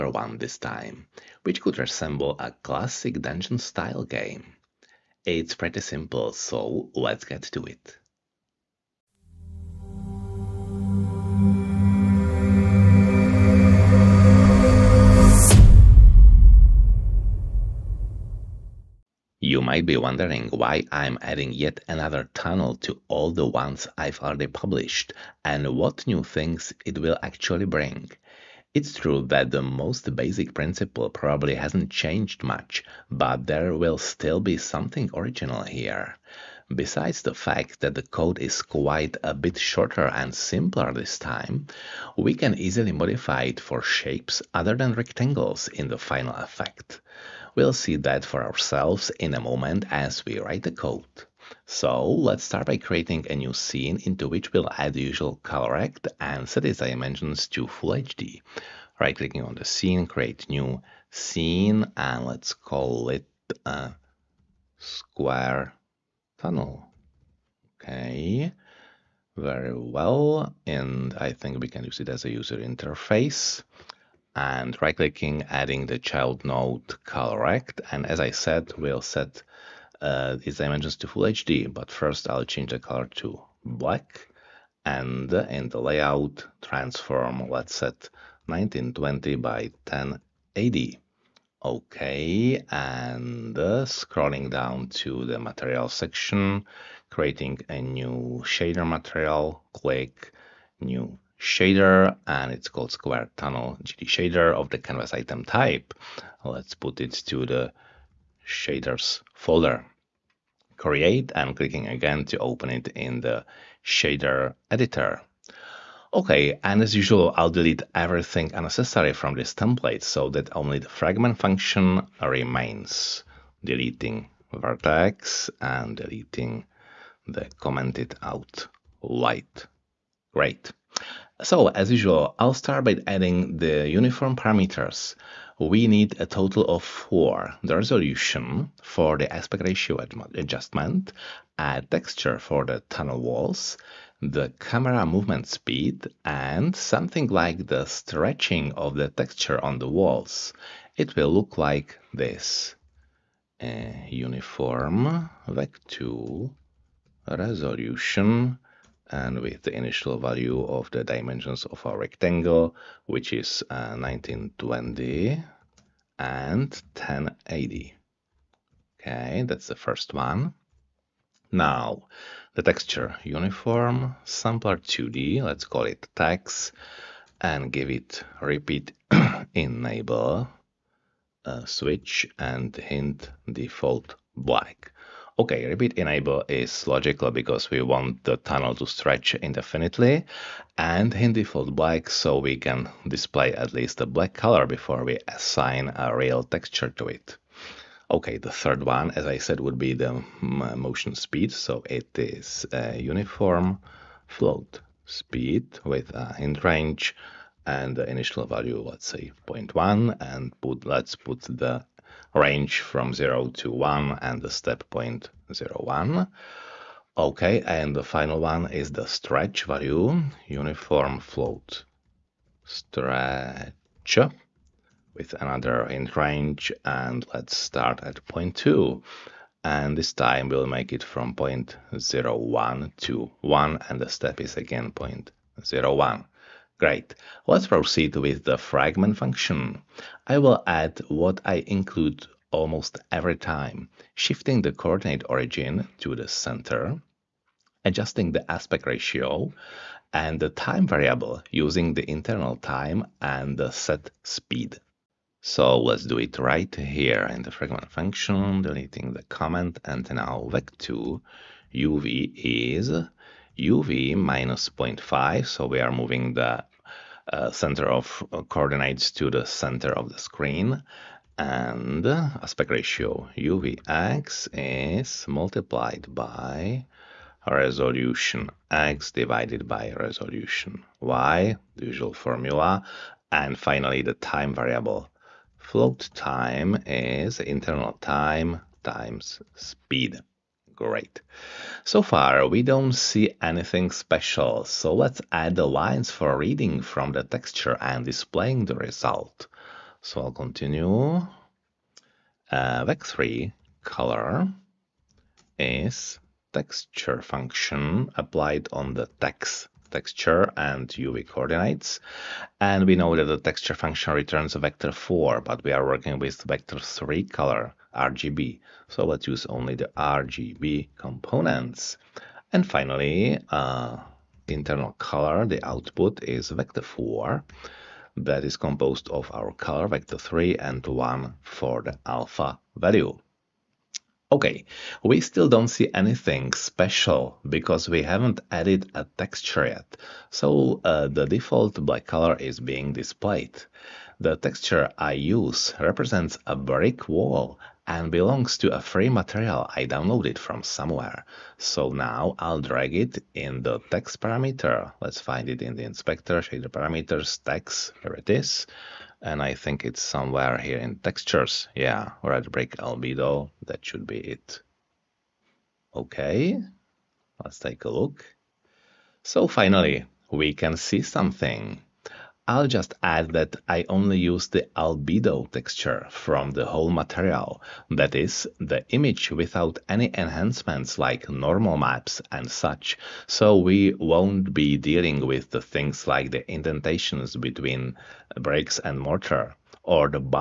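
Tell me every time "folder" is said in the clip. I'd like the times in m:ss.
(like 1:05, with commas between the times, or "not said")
1:49.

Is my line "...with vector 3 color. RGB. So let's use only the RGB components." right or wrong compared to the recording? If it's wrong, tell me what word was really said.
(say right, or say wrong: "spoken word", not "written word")
right.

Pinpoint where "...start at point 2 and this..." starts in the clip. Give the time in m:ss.
3:47.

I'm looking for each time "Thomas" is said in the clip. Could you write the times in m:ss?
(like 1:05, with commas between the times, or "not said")
not said.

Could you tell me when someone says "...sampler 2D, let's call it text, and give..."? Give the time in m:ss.
2:54.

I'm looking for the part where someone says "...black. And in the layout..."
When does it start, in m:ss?
1:23.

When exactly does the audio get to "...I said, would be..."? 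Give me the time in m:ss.
3:19.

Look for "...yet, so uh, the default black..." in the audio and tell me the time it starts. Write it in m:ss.
5:39.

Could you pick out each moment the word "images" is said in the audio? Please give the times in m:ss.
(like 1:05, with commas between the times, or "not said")
1:20, 6:18.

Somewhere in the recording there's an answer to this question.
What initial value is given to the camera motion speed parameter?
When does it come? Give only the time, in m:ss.
3:29.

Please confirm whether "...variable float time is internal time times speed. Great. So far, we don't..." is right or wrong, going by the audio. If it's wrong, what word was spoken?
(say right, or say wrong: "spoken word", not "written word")
right.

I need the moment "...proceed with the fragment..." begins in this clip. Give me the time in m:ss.
3:57.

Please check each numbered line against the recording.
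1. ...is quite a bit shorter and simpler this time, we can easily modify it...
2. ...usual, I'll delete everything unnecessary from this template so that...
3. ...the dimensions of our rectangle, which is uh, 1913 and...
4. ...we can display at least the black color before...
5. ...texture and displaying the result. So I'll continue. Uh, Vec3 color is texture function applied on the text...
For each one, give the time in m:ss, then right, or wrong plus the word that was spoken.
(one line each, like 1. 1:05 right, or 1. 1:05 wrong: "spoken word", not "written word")
1. 0:38 right
2. 1:56 right
3. 2:40 wrong: "1920", not "1913"
4. 3:12 right
5. 4:57 right.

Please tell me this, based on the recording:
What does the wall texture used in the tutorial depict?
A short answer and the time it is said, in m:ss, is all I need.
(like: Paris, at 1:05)
a brick wall, at 5:46.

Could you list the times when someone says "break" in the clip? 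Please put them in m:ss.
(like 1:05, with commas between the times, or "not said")
6:02.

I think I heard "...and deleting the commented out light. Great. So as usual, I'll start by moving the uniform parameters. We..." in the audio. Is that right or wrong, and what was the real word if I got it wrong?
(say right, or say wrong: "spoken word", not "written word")
wrong: "adding", not "moving".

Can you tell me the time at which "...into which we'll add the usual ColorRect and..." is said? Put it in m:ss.
0:54.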